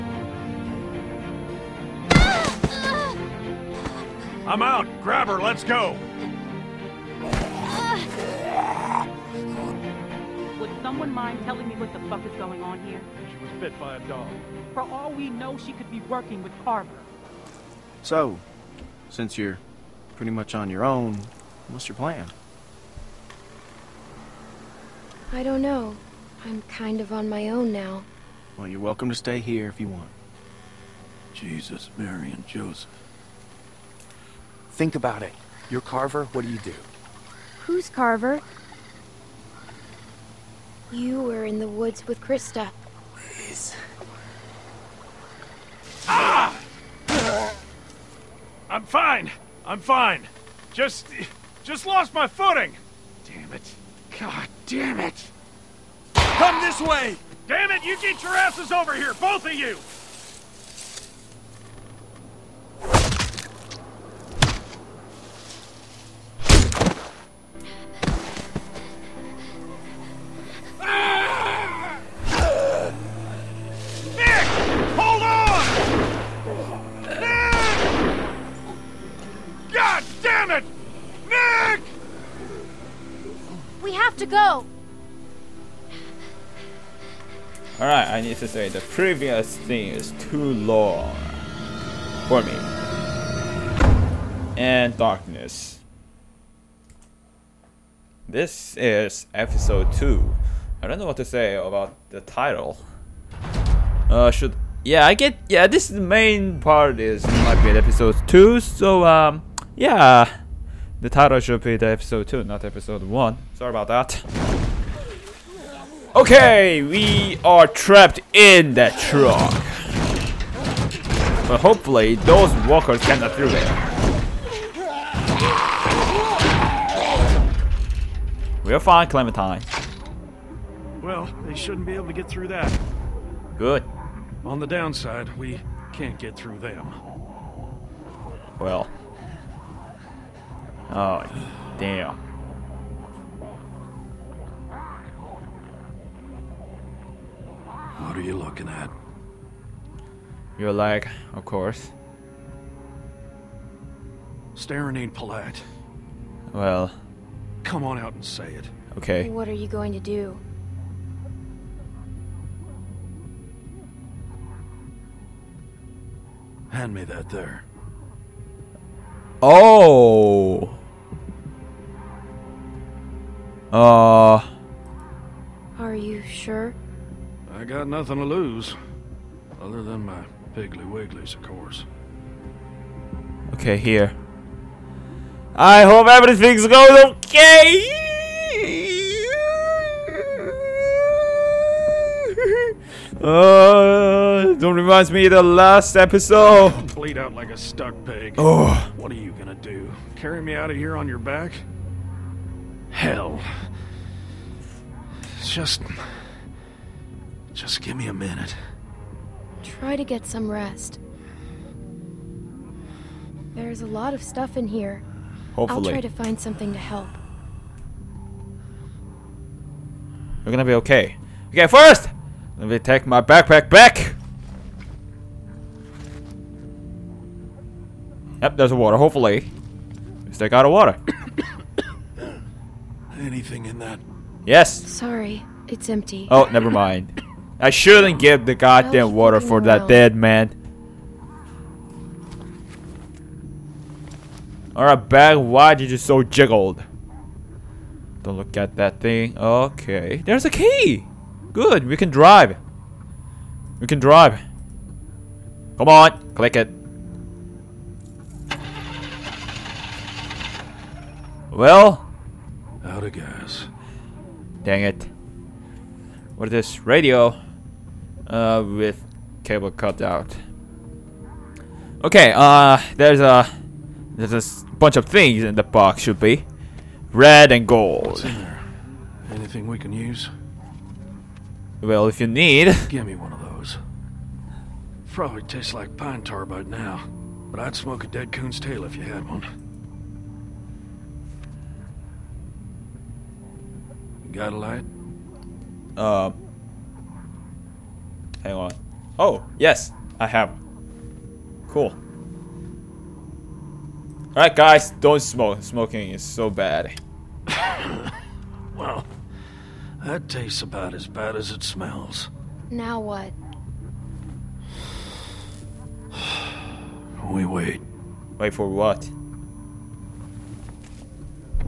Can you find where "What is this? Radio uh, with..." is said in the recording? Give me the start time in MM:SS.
04:26.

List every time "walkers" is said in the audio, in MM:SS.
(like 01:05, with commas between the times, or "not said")
02:02.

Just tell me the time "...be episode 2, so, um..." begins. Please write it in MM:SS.
01:47.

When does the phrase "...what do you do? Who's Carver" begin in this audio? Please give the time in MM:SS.
00:36.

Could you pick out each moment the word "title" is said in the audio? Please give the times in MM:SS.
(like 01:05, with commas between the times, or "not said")
01:42, 01:51.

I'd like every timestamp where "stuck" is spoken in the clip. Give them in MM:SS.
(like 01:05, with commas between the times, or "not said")
03:17.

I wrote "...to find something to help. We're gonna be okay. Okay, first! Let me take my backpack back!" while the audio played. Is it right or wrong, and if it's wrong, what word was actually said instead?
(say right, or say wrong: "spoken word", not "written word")
right.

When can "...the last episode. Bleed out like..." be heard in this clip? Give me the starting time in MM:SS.
03:15.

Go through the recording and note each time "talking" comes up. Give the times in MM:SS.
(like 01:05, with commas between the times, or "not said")
not said.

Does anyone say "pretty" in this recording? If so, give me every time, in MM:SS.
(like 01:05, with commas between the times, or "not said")
00:20.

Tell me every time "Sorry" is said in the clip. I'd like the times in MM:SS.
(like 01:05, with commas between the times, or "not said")
01:53, 03:54.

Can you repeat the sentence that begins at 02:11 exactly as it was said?
Well, they shouldn't be able to get through that.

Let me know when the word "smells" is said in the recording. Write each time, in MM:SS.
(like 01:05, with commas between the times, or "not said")
05:11.